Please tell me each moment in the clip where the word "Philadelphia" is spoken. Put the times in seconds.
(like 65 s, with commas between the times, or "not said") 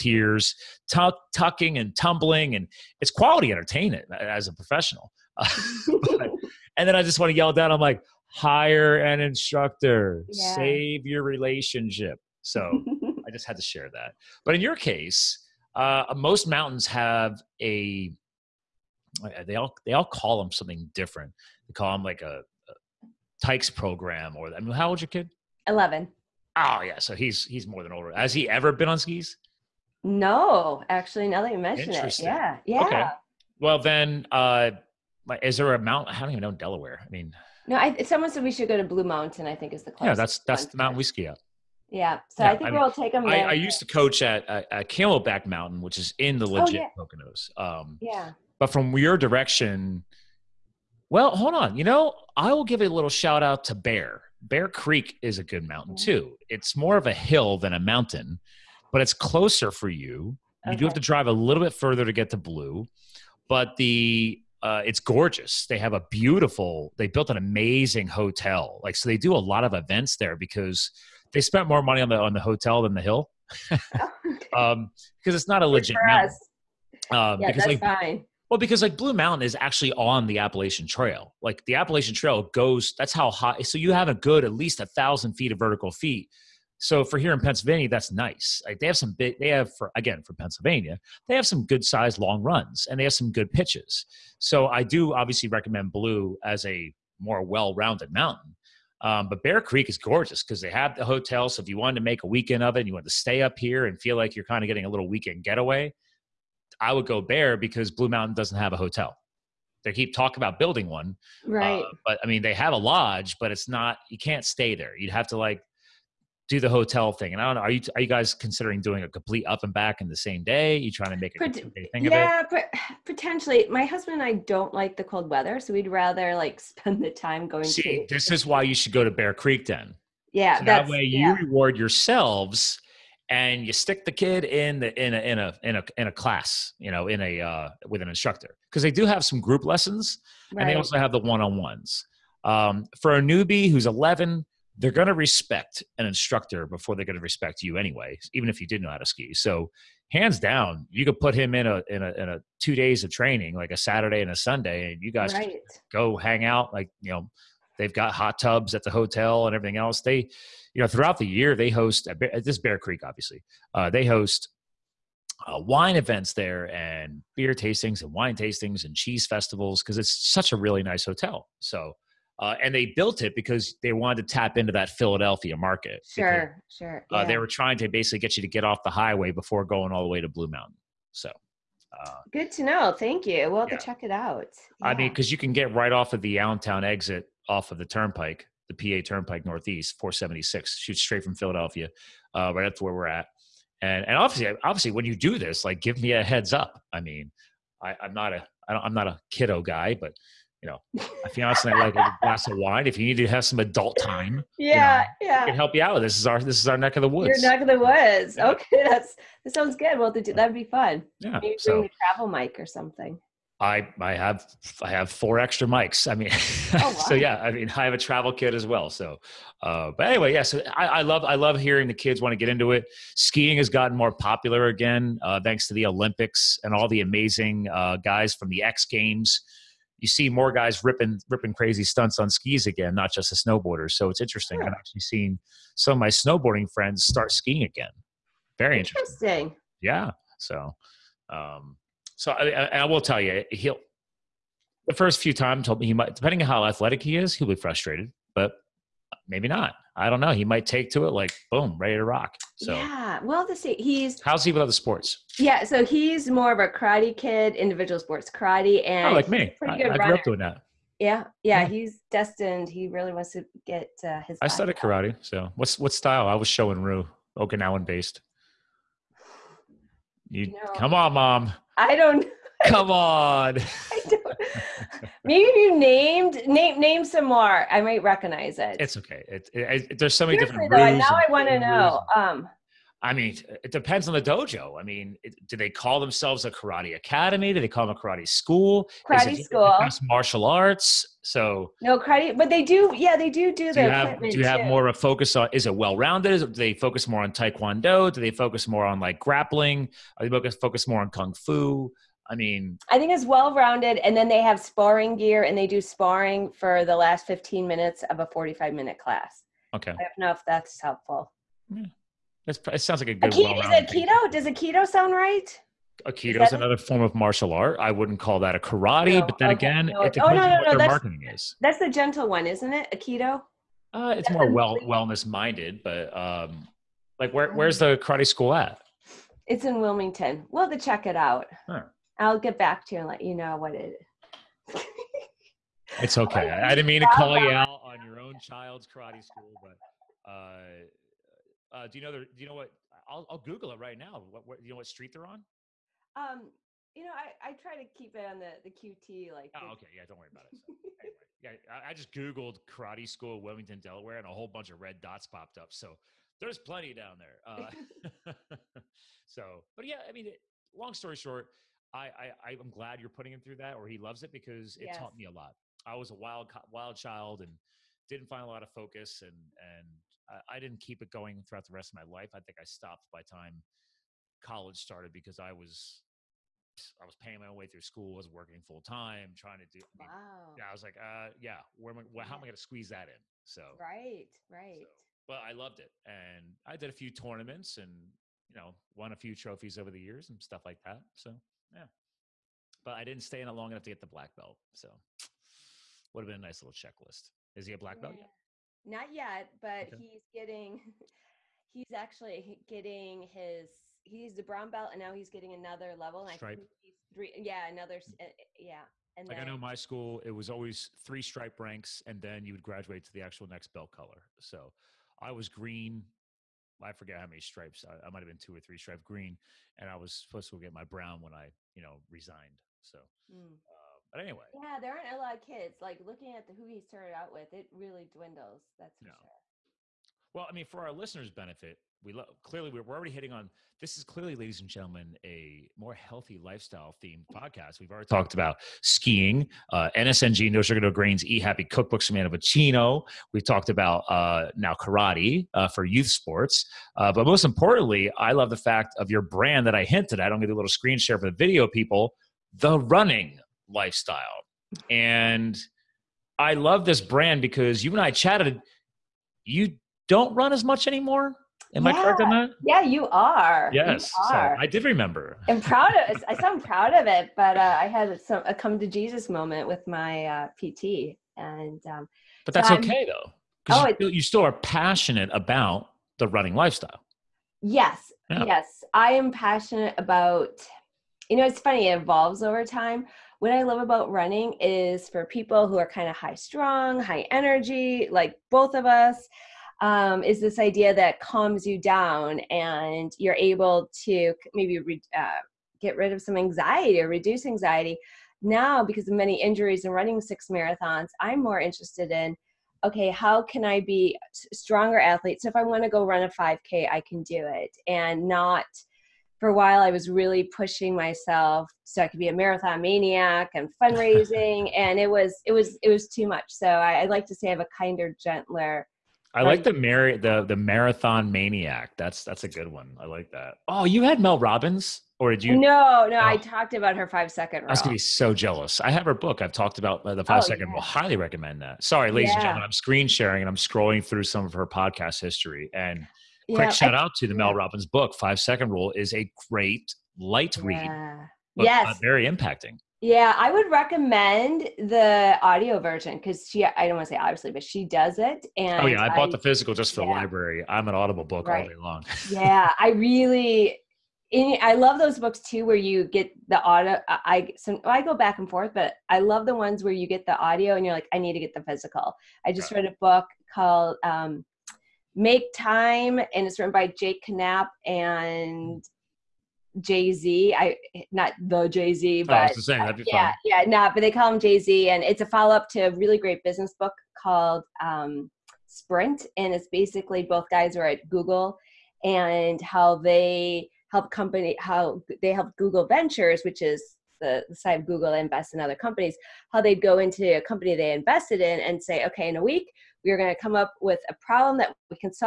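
174 s, 191 s.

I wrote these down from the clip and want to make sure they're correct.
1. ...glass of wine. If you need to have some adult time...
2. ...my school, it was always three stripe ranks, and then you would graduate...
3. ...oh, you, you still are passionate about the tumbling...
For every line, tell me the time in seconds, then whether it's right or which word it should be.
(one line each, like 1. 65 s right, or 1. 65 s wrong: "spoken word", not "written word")
1. 202 s right
2. 409 s right
3. 473 s wrong: "running", not "tumbling".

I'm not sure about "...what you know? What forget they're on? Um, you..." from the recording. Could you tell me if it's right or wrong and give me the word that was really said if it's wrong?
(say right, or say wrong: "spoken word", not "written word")
wrong: "street", not "forget".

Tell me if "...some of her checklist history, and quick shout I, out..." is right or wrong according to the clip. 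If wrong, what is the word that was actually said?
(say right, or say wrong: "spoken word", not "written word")
wrong: "podcast", not "checklist".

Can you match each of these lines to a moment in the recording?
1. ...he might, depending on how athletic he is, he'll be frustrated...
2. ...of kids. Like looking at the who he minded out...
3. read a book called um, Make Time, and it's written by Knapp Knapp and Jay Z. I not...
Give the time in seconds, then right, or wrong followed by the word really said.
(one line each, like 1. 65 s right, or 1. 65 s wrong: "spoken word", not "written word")
1. 245 s right
2. 425 s wrong: "started", not "minded"
3. 562 s wrong: "Jake", not "Knapp".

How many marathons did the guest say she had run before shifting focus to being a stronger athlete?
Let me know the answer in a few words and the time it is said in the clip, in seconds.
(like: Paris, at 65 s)
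6, at 500 s.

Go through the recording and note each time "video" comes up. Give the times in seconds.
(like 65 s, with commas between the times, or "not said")
451 s.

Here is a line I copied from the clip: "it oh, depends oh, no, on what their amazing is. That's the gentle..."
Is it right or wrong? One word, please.
wrong.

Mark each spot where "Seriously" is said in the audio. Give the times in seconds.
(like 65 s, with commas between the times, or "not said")
280 s.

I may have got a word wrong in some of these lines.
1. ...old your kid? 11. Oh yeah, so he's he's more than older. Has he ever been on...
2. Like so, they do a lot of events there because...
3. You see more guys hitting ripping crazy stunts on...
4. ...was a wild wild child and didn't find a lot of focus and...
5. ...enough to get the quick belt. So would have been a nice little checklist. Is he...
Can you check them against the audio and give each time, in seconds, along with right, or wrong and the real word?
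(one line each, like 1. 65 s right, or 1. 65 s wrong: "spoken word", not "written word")
1. 24 s right
2. 68 s right
3. 229 s wrong: "ripping", not "hitting"
4. 365 s right
5. 393 s wrong: "black", not "quick".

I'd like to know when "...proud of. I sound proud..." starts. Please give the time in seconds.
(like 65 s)
465 s.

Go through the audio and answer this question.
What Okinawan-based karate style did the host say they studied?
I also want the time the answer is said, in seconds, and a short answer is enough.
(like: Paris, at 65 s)
Shorin-ryu, at 266 s.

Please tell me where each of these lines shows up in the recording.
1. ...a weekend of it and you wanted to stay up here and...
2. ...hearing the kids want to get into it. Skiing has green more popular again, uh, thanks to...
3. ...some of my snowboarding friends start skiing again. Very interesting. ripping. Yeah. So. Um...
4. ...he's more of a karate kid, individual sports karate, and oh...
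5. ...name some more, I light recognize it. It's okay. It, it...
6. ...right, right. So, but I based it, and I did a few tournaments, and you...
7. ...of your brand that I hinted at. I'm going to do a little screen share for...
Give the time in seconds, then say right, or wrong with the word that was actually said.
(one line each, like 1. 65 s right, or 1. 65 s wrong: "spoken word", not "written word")
1. 102 s right
2. 221 s wrong: "gotten", not "green"
3. 235 s wrong: "interesting", not "ripping"
4. 255 s right
5. 276 s wrong: "might", not "light"
6. 383 s wrong: "loved", not "based"
7. 448 s right.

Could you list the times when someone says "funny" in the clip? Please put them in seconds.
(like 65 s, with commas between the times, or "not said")
481 s.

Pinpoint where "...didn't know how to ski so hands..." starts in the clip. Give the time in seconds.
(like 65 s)
148 s.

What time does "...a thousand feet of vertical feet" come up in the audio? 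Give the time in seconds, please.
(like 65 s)
84 s.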